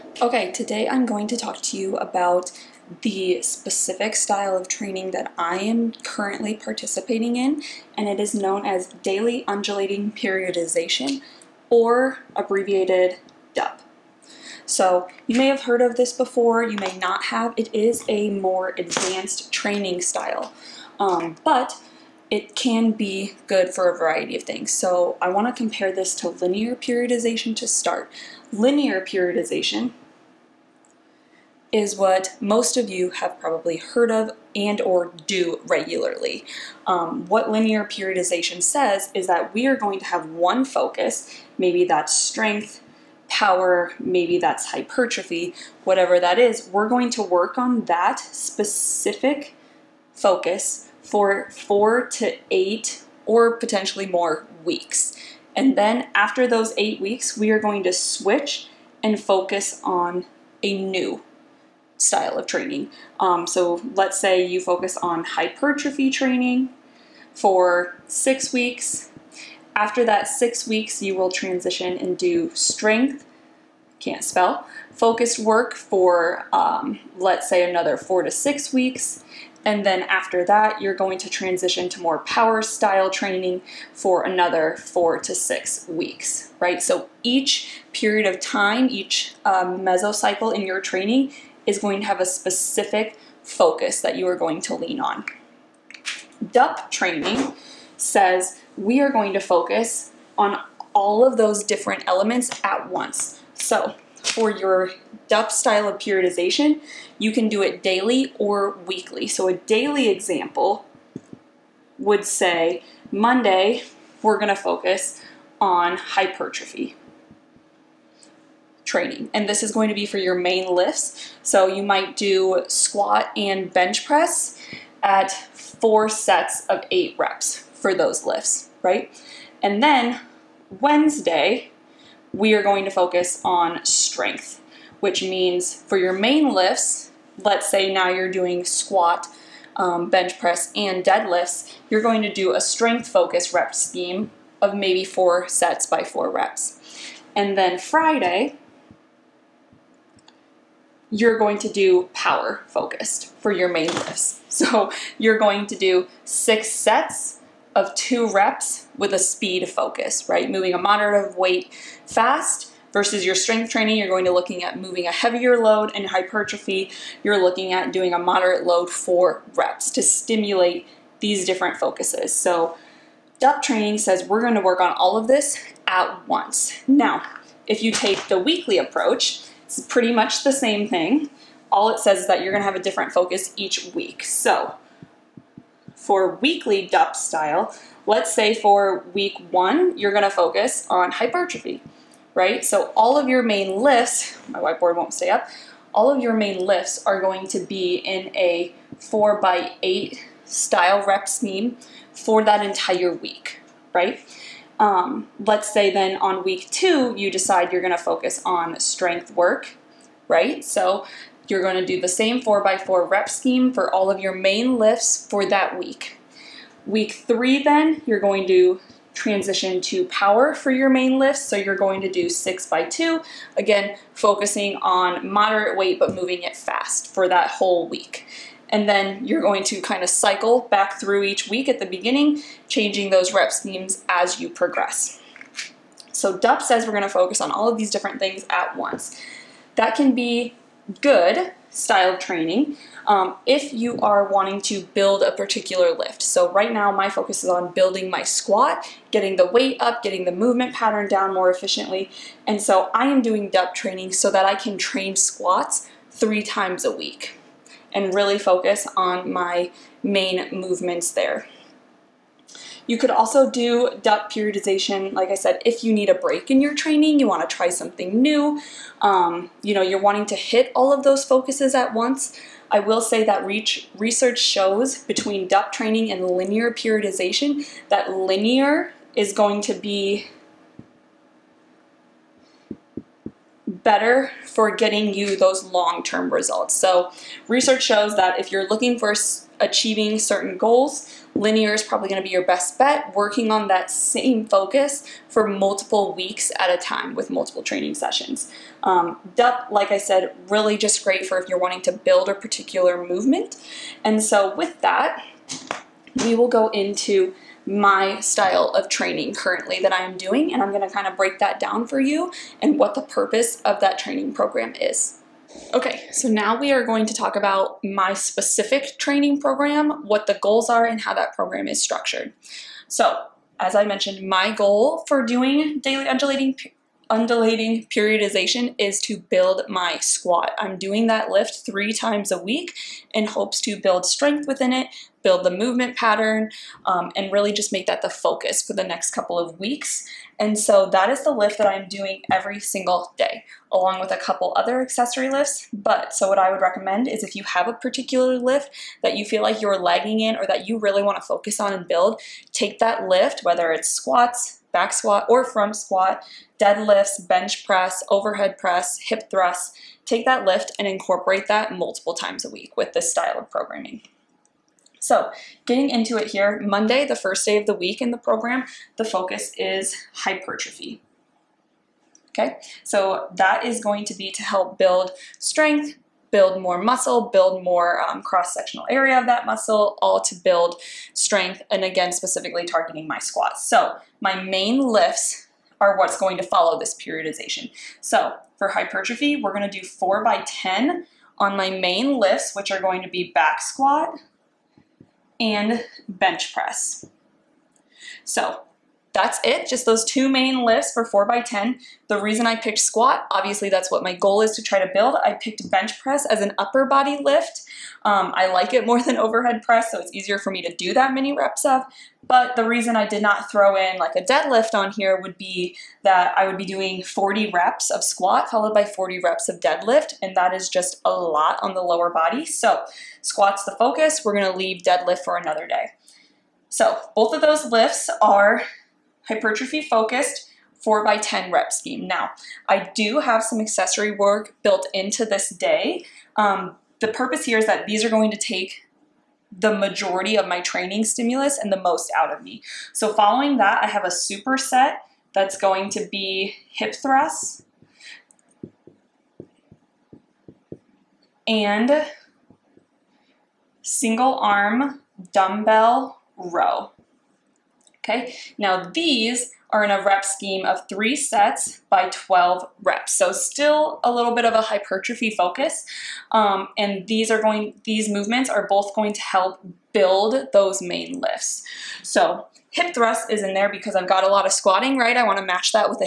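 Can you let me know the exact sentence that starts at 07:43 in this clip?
So still a little bit of a hypertrophy focus.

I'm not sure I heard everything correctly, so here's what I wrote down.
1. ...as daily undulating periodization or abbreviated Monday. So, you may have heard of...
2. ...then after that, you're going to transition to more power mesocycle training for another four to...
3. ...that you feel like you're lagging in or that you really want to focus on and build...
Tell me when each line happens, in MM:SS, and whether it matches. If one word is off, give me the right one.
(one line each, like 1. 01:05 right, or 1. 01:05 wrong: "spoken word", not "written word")
1. 00:08 wrong: "DUP", not "Monday"
2. 01:19 wrong: "style", not "mesocycle"
3. 05:49 right.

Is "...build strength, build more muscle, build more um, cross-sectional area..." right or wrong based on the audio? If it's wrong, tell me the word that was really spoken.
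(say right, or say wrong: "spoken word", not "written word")
right.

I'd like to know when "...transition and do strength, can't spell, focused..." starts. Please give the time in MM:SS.
01:11.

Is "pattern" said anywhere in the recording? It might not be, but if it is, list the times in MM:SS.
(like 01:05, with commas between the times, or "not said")
04:10, 05:35.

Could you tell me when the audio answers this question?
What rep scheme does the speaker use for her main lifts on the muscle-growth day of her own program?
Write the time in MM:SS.
06:29.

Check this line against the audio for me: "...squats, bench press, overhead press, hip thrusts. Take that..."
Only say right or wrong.
wrong.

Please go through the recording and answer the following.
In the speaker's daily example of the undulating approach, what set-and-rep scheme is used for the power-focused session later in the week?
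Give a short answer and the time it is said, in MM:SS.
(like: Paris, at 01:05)
6 sets of 2 reps, at 02:36.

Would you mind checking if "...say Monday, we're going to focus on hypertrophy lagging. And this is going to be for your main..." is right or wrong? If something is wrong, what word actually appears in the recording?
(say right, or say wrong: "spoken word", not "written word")
wrong: "training", not "lagging".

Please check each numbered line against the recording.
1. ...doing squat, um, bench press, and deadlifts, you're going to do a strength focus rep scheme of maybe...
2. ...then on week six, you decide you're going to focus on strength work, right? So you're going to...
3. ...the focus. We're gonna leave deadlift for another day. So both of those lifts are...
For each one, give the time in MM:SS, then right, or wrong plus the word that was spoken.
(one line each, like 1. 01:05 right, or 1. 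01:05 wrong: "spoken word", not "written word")
1. 02:18 right
2. 03:25 wrong: "two", not "six"
3. 07:03 right.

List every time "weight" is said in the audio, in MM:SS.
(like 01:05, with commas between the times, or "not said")
02:41, 03:45, 04:09.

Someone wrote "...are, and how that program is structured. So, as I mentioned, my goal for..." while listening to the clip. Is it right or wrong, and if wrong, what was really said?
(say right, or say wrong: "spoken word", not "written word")
right.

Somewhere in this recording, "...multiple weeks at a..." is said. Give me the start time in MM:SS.
04:55.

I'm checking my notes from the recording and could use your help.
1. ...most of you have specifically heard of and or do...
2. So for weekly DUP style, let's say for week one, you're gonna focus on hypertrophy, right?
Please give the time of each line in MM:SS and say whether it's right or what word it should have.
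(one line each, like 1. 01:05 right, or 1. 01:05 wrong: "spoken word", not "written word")
1. 00:32 wrong: "probably", not "specifically"
2. 03:04 right.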